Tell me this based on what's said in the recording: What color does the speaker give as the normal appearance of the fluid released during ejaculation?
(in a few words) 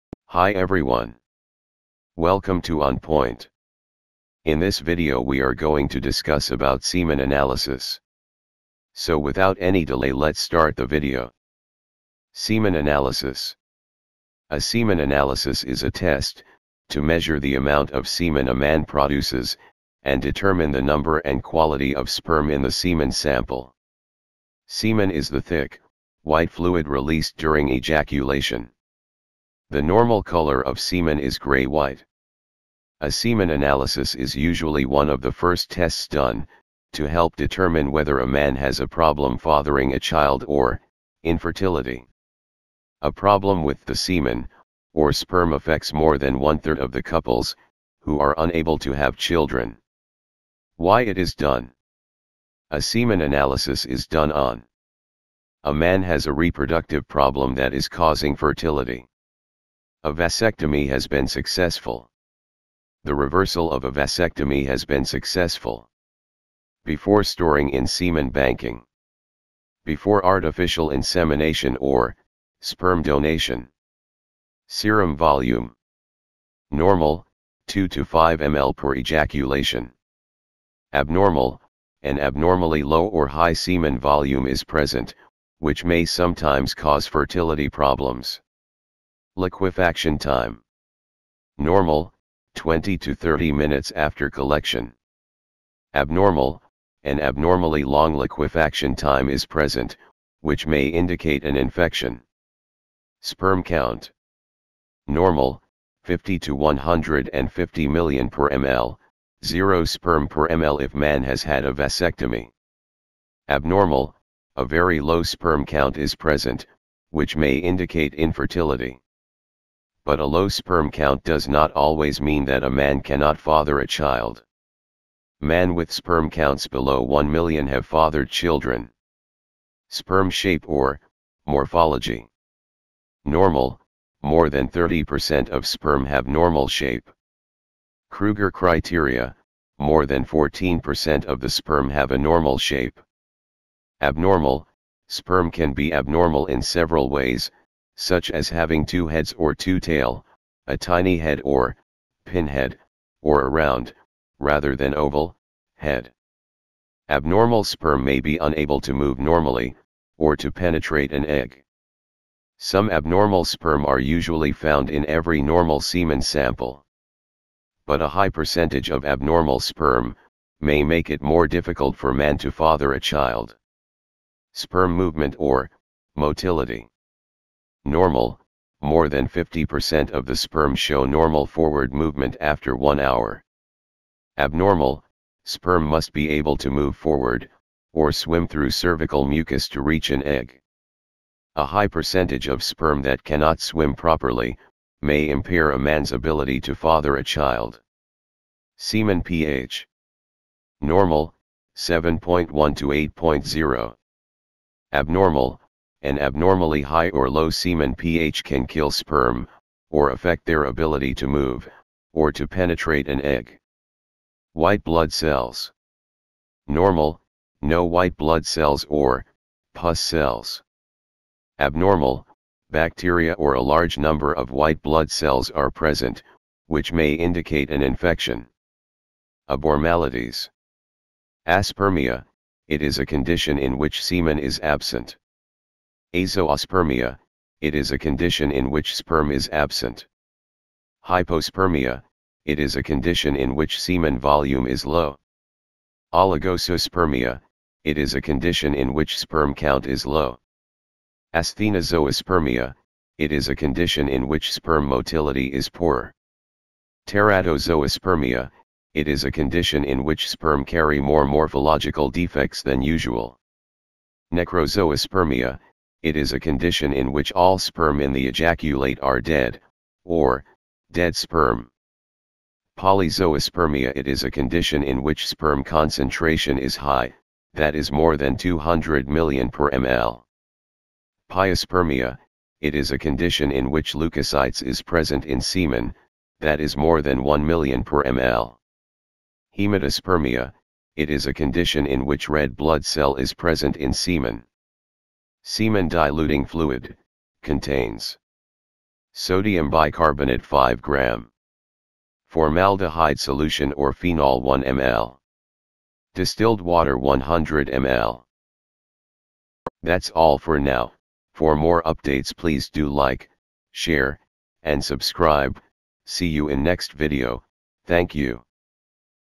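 gray-white.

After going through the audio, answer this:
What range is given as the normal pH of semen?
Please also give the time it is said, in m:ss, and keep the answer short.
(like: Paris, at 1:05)
7.1 to 8.0, at 3:21.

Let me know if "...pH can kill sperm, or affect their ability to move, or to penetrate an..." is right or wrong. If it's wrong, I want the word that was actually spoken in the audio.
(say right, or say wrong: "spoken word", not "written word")
right.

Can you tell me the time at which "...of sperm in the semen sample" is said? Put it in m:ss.
0:21.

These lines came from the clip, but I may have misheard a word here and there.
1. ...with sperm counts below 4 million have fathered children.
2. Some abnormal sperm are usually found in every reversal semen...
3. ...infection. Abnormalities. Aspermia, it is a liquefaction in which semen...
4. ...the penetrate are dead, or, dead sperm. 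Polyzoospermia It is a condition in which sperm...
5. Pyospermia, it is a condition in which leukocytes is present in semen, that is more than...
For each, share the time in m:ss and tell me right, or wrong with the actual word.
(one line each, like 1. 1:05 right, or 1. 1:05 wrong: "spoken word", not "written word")
1. 2:05 wrong: "1", not "4"
2. 2:42 wrong: "normal", not "reversal"
3. 3:47 wrong: "condition", not "liquefaction"
4. 4:28 wrong: "ejaculate", not "penetrate"
5. 4:41 right.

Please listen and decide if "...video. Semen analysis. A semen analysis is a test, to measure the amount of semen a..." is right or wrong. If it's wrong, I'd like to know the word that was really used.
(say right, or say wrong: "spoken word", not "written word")
right.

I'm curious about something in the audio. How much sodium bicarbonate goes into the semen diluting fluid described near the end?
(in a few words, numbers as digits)
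5 gram.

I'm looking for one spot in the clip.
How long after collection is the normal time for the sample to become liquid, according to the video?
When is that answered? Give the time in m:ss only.
1:32.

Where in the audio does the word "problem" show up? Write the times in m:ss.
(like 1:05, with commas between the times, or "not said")
0:38, 0:43, 0:57, 1:27.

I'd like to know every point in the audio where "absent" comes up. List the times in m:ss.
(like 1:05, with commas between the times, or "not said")
3:54, 3:59.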